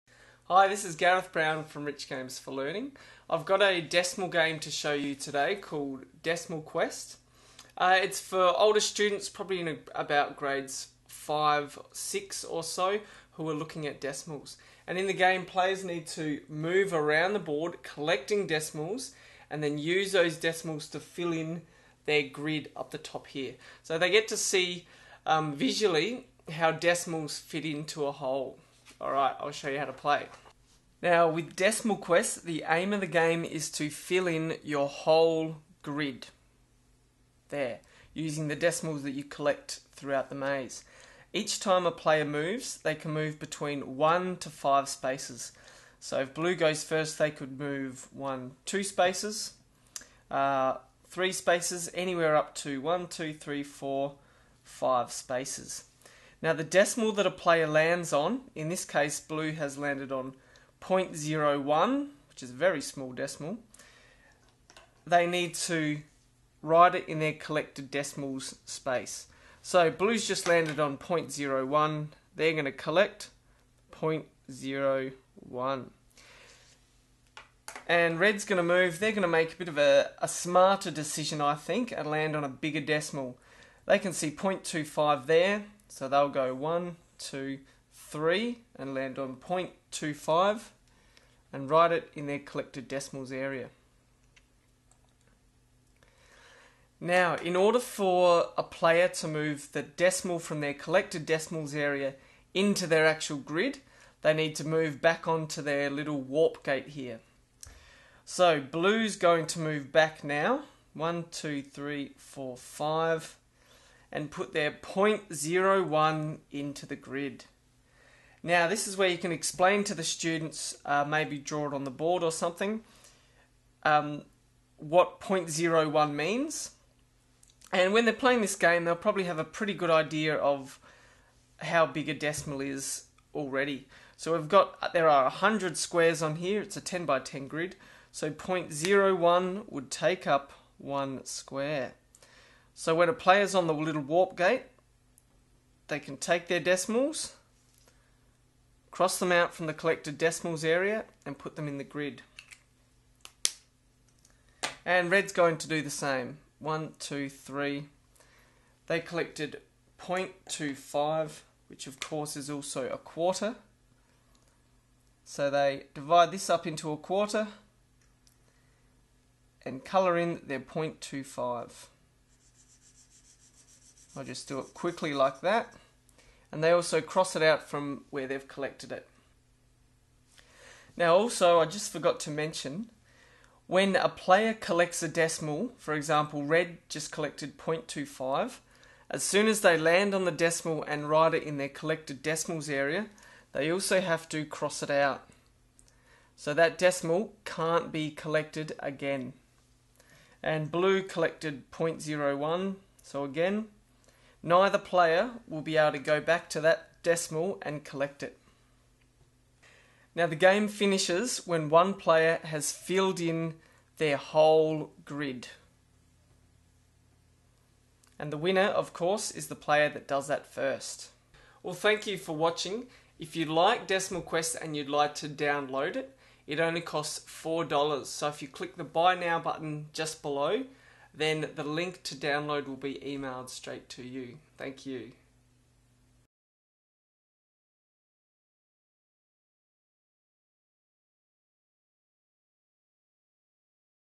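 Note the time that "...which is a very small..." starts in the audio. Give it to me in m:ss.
1:02.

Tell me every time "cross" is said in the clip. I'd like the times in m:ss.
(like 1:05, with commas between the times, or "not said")
2:28, 2:56, 3:14.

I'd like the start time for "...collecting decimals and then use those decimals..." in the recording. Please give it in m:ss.
0:17.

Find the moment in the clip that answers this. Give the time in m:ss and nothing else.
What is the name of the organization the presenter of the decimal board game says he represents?
0:01.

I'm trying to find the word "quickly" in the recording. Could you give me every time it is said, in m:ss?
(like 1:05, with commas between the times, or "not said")
2:54.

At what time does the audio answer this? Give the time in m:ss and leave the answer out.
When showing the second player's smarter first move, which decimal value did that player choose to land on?
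1:24.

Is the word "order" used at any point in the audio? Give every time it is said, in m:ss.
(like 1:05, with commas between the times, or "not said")
1:37.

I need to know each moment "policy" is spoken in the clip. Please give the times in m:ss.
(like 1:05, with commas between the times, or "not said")
not said.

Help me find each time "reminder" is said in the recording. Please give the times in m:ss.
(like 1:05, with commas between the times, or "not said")
not said.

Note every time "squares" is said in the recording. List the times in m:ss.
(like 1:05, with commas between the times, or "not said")
2:15, 2:21.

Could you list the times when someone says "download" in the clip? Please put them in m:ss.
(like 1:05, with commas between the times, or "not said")
3:45, 3:52.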